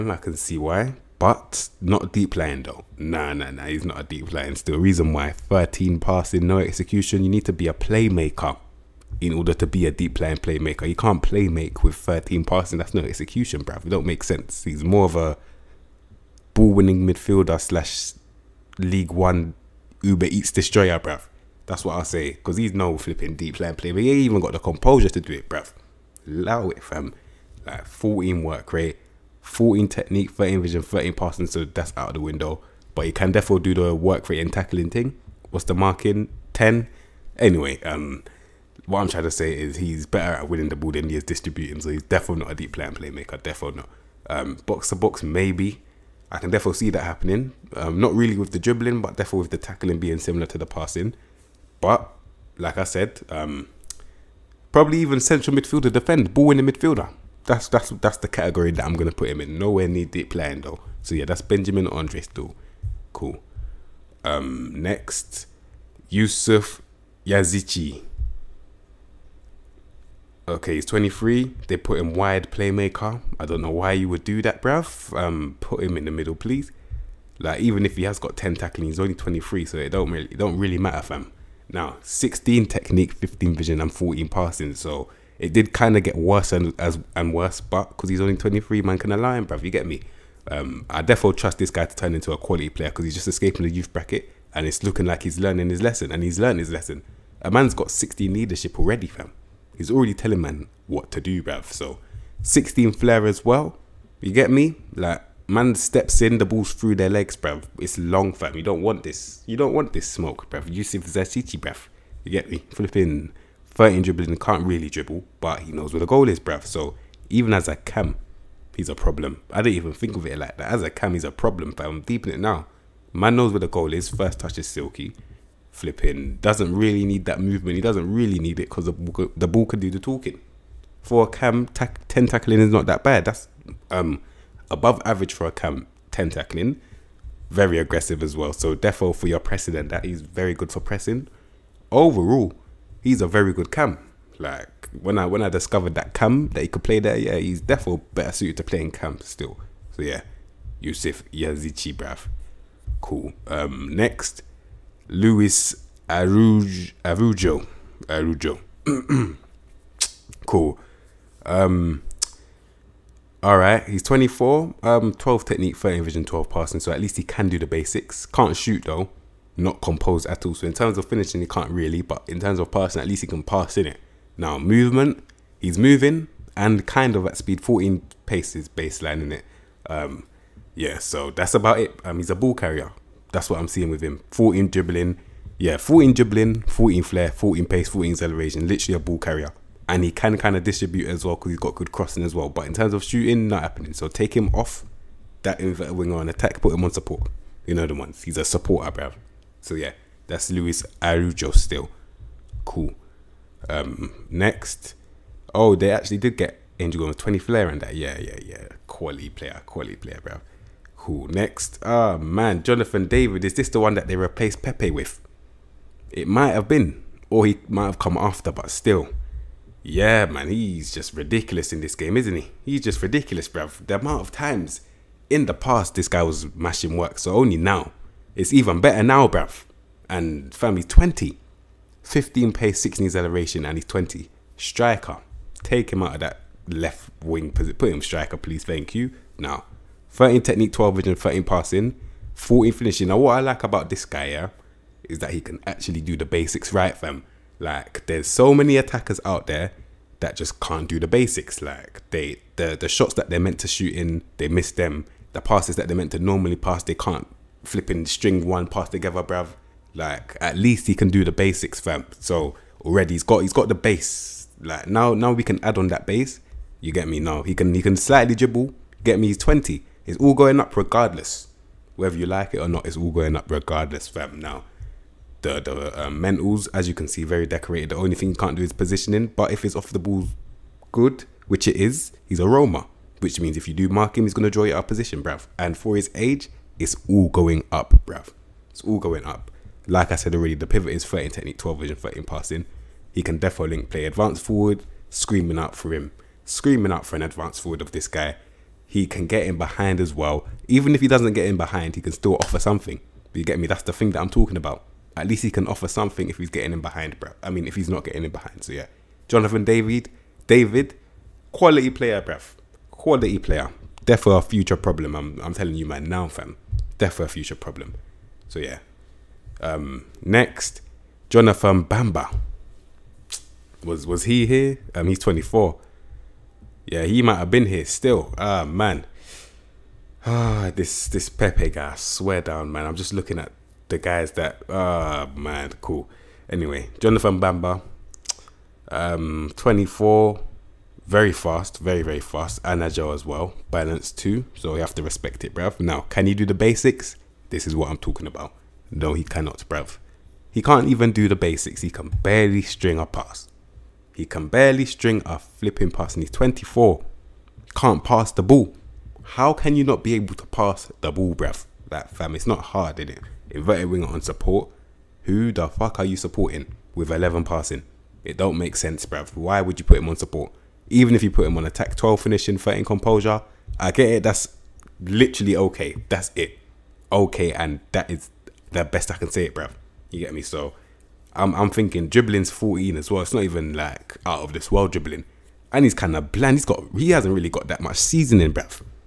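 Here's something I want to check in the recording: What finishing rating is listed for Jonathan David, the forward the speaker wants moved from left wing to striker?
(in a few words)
14.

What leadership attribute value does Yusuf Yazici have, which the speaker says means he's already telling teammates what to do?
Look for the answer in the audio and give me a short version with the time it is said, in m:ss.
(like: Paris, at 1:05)
16, at 1:37.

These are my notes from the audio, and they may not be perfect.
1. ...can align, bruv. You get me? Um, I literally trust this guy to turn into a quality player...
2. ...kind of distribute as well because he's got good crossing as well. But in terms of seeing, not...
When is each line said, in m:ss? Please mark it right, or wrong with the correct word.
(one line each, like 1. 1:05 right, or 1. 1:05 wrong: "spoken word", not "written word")
1. 1:28 wrong: "definitely", not "literally"
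2. 3:10 wrong: "shooting", not "seeing".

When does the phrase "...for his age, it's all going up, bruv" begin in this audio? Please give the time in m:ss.
4:45.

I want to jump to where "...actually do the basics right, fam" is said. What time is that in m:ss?
4:05.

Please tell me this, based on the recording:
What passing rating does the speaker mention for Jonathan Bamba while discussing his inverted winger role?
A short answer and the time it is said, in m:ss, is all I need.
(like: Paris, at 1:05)
11, at 6:07.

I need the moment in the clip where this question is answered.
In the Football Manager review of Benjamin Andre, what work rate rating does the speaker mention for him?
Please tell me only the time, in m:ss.
0:27.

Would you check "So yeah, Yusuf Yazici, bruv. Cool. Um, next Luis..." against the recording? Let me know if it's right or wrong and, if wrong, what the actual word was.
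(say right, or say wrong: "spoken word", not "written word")
right.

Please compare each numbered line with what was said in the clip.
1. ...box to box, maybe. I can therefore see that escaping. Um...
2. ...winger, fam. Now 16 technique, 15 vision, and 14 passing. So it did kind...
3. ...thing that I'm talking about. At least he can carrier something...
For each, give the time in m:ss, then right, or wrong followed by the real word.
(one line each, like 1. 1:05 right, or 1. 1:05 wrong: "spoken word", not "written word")
1. 0:44 wrong: "happening", not "escaping"
2. 1:20 wrong: "matter", not "winger"
3. 5:03 wrong: "offer", not "carrier".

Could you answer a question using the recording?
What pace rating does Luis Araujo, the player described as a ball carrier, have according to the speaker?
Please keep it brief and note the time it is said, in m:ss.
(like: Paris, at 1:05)
14, at 2:57.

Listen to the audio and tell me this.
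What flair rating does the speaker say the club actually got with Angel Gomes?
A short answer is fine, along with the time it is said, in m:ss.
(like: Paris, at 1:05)
20, at 3:27.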